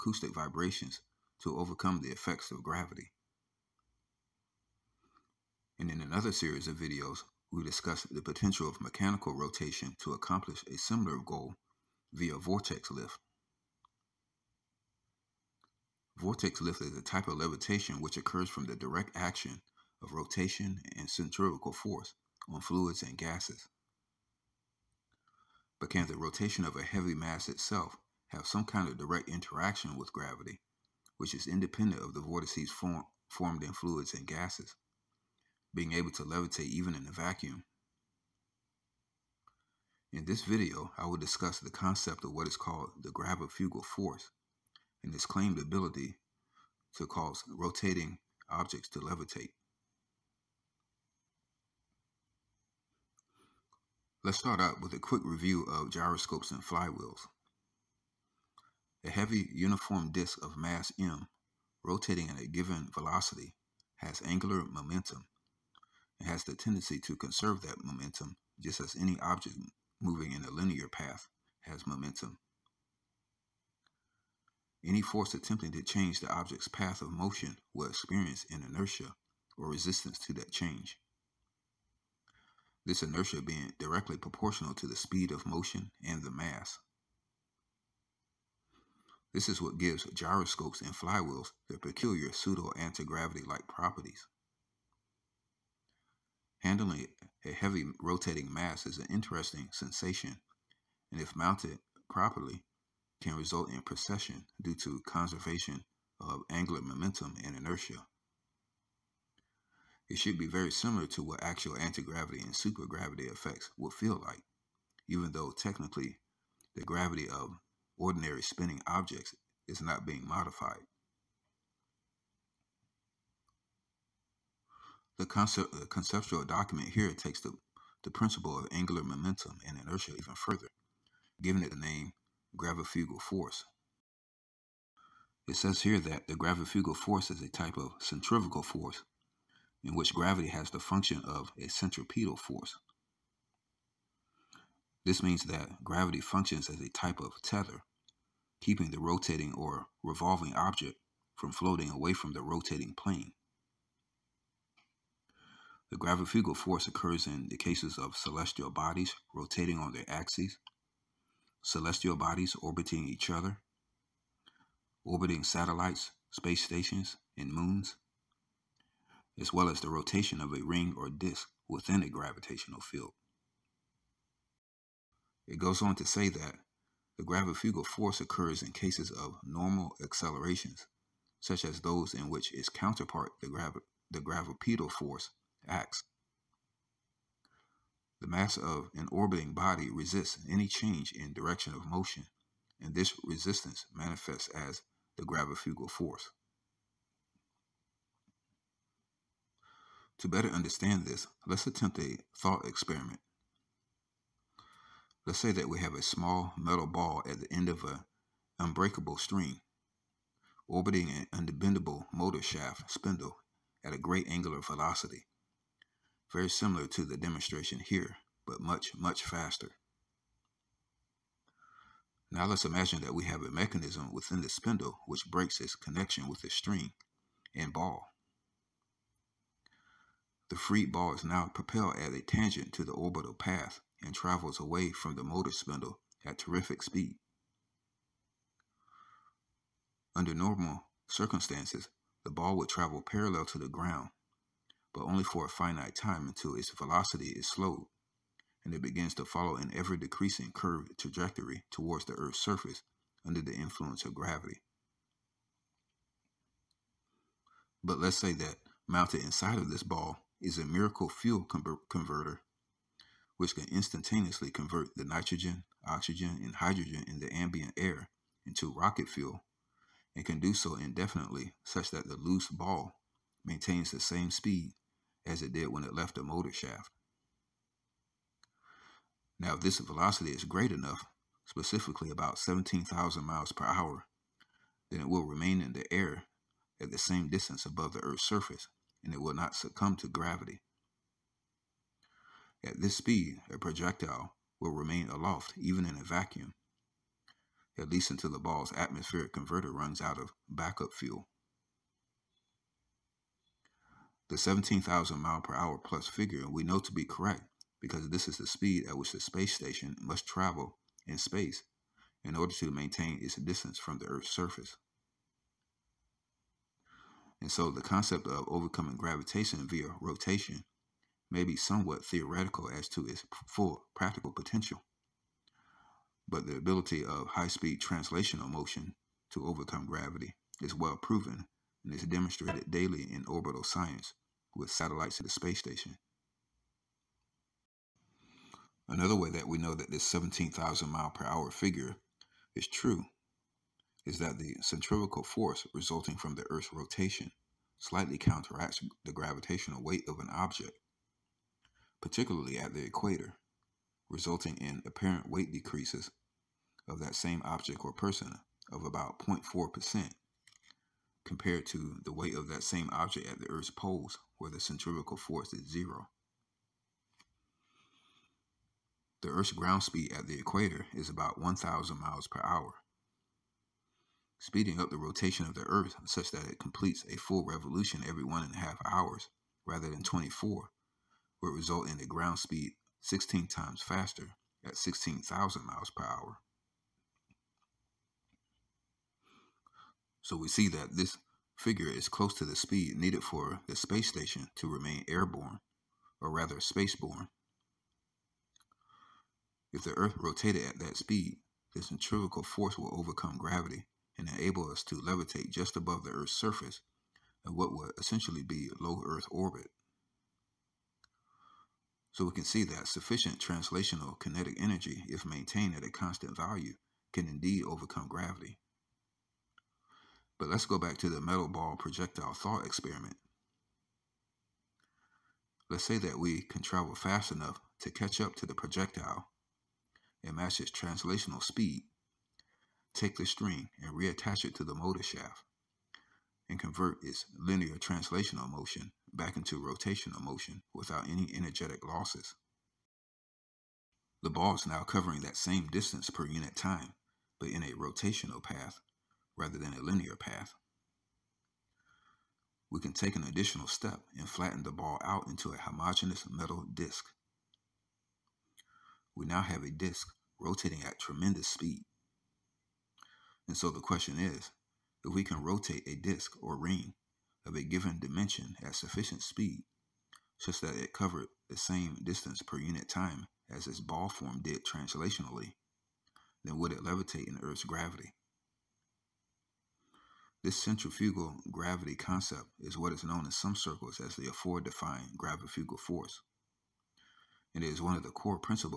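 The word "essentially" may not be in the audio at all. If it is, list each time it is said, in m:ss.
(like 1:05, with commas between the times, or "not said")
6:47.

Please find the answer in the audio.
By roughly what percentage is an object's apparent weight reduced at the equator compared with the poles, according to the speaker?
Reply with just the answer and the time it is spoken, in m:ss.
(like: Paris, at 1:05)
0.4%, at 5:59.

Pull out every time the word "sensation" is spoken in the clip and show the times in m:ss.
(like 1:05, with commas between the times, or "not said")
1:39.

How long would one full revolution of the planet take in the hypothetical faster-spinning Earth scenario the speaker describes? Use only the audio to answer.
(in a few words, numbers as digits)
1.5 hours.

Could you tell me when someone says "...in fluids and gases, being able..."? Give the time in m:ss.
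0:33.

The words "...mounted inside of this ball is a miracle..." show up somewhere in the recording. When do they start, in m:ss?
4:18.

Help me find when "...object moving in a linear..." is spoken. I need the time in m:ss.
1:09.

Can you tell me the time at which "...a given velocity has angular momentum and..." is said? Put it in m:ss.
1:02.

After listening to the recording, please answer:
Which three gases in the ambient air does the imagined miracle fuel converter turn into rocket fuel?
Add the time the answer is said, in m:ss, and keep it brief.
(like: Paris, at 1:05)
nitrogen, oxygen, and hydrogen, at 4:25.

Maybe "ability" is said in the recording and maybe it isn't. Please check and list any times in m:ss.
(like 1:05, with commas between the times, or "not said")
0:45, 5:26.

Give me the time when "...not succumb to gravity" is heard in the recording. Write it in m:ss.
4:49.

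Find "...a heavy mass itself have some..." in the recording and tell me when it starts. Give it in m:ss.
0:26.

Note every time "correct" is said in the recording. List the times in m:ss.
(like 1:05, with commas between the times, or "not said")
5:07.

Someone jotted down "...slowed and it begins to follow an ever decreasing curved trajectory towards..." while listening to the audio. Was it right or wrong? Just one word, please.
right.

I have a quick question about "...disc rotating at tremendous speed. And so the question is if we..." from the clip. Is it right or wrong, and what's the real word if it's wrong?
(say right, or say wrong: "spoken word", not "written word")
right.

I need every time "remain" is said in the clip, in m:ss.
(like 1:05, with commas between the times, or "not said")
4:45, 4:54, 6:34.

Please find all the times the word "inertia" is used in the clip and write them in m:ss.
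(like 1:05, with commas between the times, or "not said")
1:18, 1:23, 1:47, 2:09.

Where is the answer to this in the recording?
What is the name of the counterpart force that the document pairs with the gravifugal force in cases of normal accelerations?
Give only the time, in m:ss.
3:04.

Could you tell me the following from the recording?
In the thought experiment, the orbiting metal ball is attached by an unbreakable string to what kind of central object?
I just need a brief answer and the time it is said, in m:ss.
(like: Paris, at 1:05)
motor shaft spindle, at 3:32.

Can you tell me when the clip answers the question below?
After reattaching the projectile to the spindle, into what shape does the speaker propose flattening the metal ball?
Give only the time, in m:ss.
7:35.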